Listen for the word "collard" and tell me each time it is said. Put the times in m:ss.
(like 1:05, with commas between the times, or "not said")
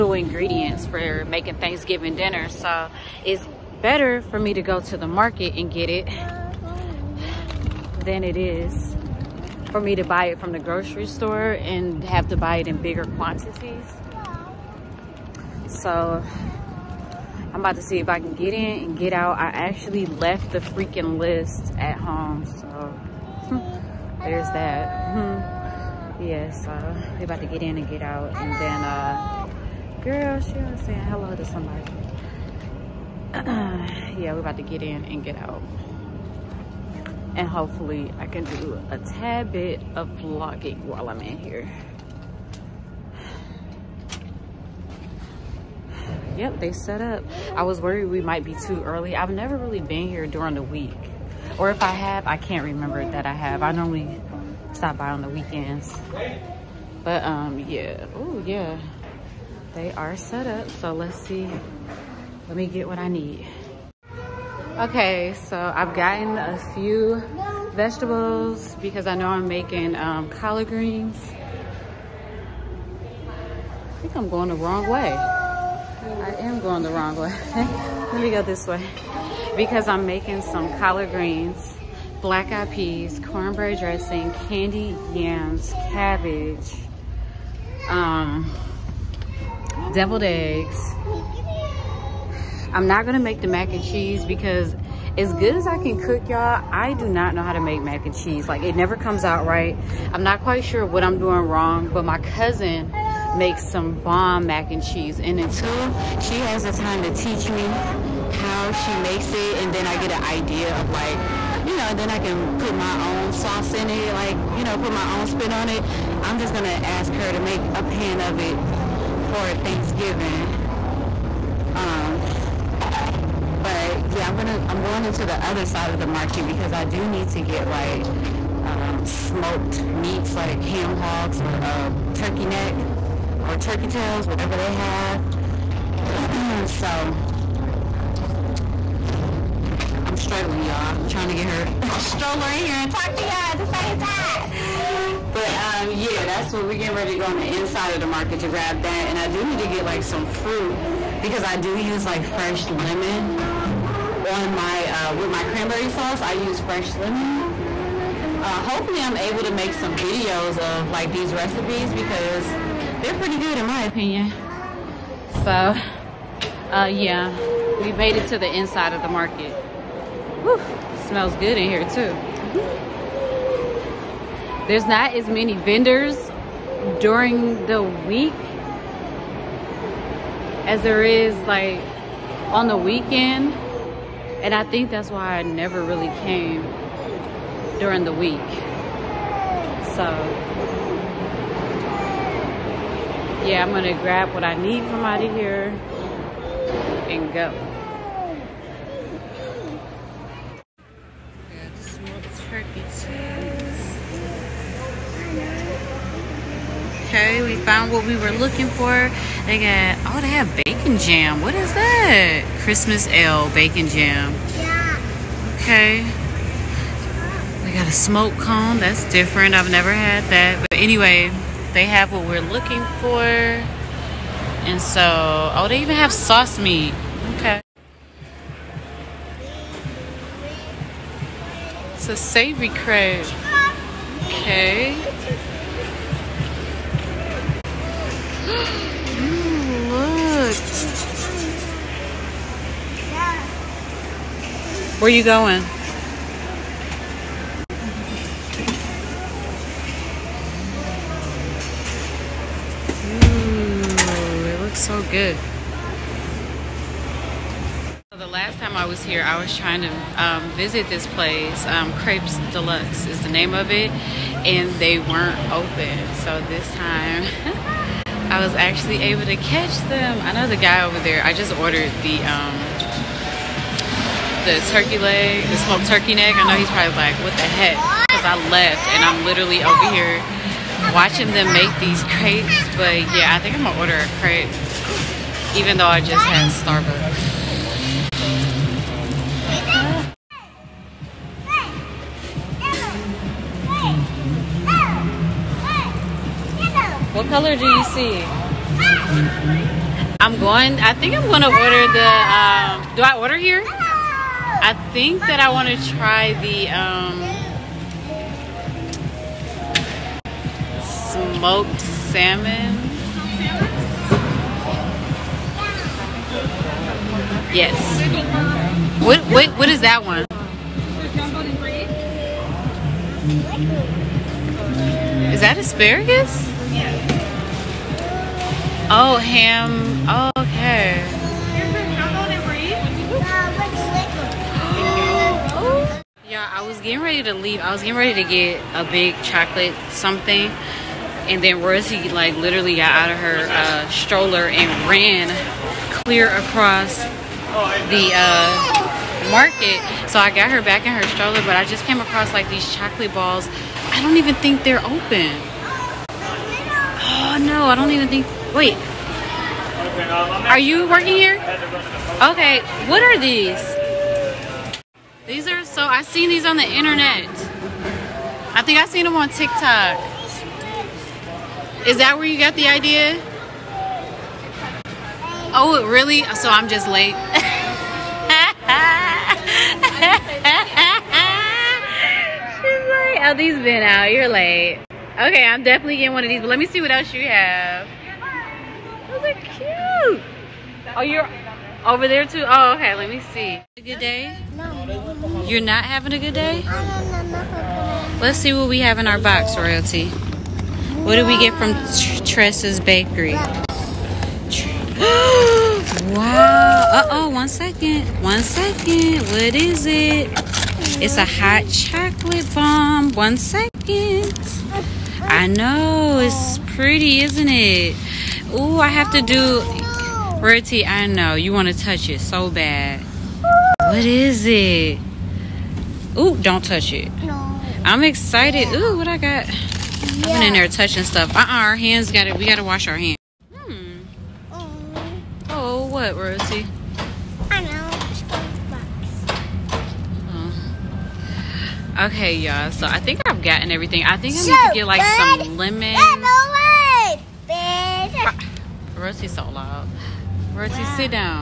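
1:10, 1:20.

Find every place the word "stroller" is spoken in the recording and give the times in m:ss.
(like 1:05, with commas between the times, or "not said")
2:21, 5:43, 5:51.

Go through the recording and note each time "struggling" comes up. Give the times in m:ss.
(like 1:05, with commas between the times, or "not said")
2:20.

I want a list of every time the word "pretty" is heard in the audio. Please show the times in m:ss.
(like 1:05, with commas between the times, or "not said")
2:43, 6:56.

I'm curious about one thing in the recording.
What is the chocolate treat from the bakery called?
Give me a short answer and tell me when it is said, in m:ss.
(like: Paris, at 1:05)
Hot chocolate bomb, at 6:51.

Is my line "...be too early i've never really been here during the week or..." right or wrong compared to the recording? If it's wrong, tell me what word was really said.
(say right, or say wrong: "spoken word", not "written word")
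right.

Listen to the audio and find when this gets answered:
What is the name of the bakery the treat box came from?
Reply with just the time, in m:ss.
6:42.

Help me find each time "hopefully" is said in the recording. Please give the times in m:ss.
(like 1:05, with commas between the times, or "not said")
0:37, 2:38.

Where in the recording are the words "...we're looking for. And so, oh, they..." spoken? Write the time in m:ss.
3:42.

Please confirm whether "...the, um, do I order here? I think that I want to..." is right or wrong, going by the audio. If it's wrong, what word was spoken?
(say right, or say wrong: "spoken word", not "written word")
right.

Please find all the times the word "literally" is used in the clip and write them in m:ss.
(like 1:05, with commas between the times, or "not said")
4:39, 5:42.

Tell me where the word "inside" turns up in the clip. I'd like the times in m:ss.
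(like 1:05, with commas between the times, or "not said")
2:27, 2:48.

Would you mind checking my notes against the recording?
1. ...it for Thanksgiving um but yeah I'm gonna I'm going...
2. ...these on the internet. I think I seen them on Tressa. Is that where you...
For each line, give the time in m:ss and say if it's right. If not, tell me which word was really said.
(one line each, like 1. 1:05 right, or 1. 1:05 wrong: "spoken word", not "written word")
1. 1:58 right
2. 6:06 wrong: "TikTok", not "Tressa".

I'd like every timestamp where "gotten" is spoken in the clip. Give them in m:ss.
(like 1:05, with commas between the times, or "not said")
1:05, 7:23.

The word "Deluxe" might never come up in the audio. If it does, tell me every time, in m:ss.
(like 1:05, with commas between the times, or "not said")
4:22.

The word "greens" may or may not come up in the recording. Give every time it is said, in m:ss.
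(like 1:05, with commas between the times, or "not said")
1:10, 1:21.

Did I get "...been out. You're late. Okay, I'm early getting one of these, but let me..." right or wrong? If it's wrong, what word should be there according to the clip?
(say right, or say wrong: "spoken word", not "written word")
wrong: "definitely", not "early".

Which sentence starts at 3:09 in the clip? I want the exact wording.
So yeah, I'm gonna grab what I need from out of here and go.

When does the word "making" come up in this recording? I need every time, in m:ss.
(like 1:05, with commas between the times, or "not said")
0:01, 1:09, 1:20.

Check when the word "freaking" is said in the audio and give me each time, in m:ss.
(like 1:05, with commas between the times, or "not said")
0:20.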